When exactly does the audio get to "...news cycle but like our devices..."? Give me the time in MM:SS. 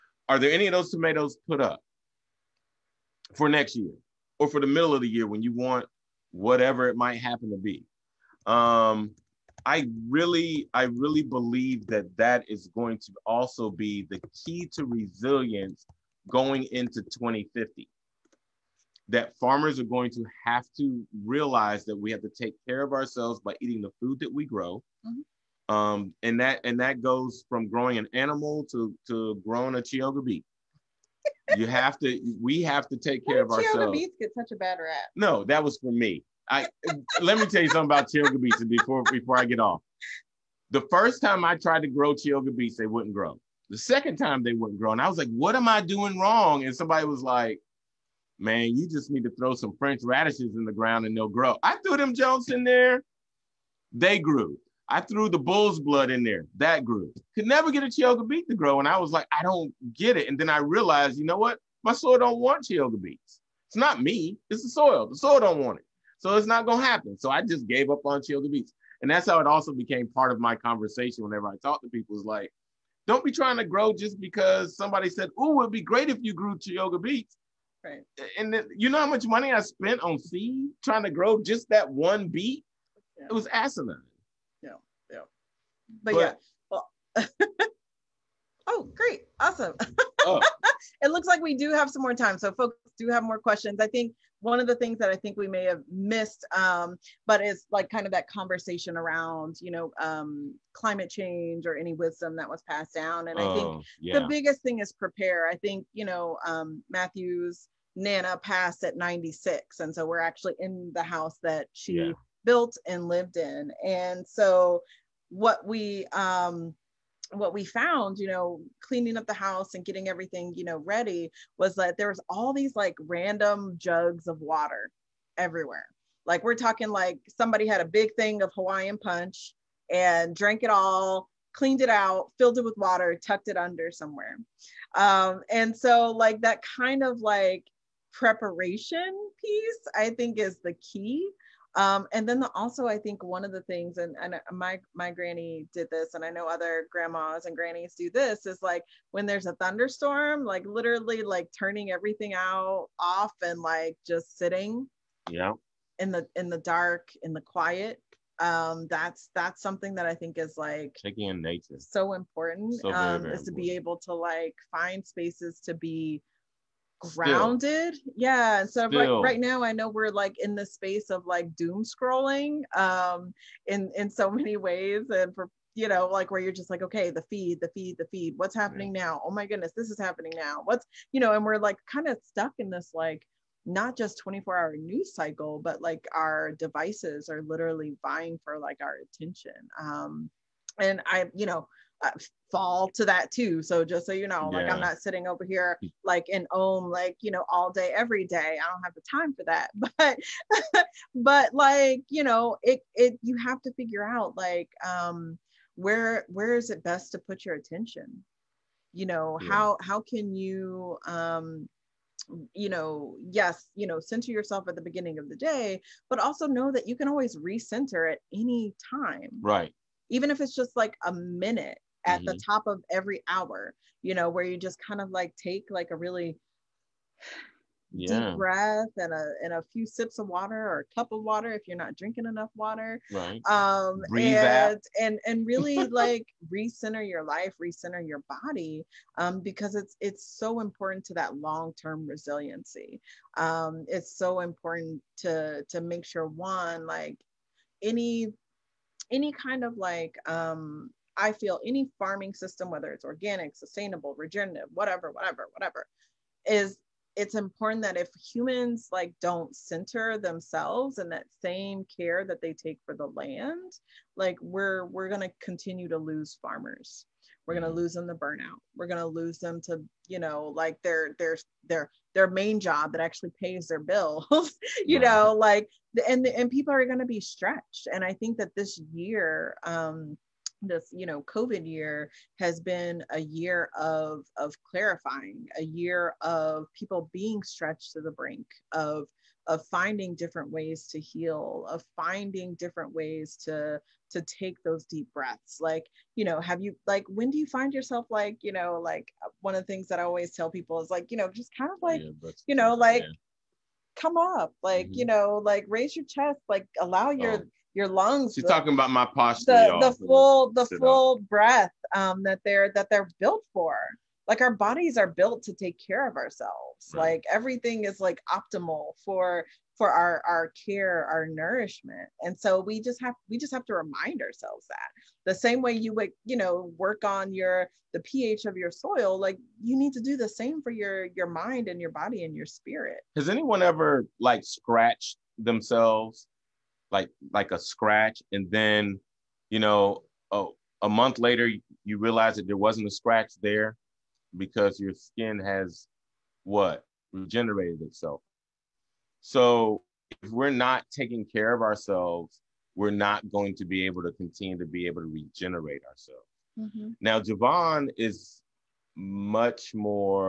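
03:04.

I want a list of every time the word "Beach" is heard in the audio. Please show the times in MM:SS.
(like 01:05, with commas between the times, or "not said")
00:38, 00:42.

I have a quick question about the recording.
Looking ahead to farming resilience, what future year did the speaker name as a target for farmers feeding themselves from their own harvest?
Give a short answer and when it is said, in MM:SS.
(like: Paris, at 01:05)
2050, at 00:17.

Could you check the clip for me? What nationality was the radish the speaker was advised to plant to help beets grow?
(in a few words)
French.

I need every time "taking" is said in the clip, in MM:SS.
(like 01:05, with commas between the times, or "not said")
02:41, 05:50.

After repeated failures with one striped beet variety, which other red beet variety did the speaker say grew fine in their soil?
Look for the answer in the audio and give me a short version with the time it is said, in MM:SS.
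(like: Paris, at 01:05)
Bulls Blood, at 00:55.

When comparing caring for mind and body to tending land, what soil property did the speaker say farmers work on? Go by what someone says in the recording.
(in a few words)
pH.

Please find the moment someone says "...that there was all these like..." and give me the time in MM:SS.
02:01.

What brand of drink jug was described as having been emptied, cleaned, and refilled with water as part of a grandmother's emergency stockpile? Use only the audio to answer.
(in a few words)
Hawaiian Punch.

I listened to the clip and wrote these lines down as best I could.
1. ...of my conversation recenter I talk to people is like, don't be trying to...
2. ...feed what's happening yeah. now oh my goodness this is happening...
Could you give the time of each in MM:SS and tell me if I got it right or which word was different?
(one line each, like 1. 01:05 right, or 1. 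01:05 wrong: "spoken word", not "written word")
1. 01:10 wrong: "whenever", not "recenter"
2. 02:58 right.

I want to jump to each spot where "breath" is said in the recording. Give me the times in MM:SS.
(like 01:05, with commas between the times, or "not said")
03:48, 04:55, 05:11.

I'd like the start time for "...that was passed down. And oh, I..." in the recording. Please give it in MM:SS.
01:42.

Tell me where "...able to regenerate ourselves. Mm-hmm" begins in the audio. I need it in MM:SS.
05:54.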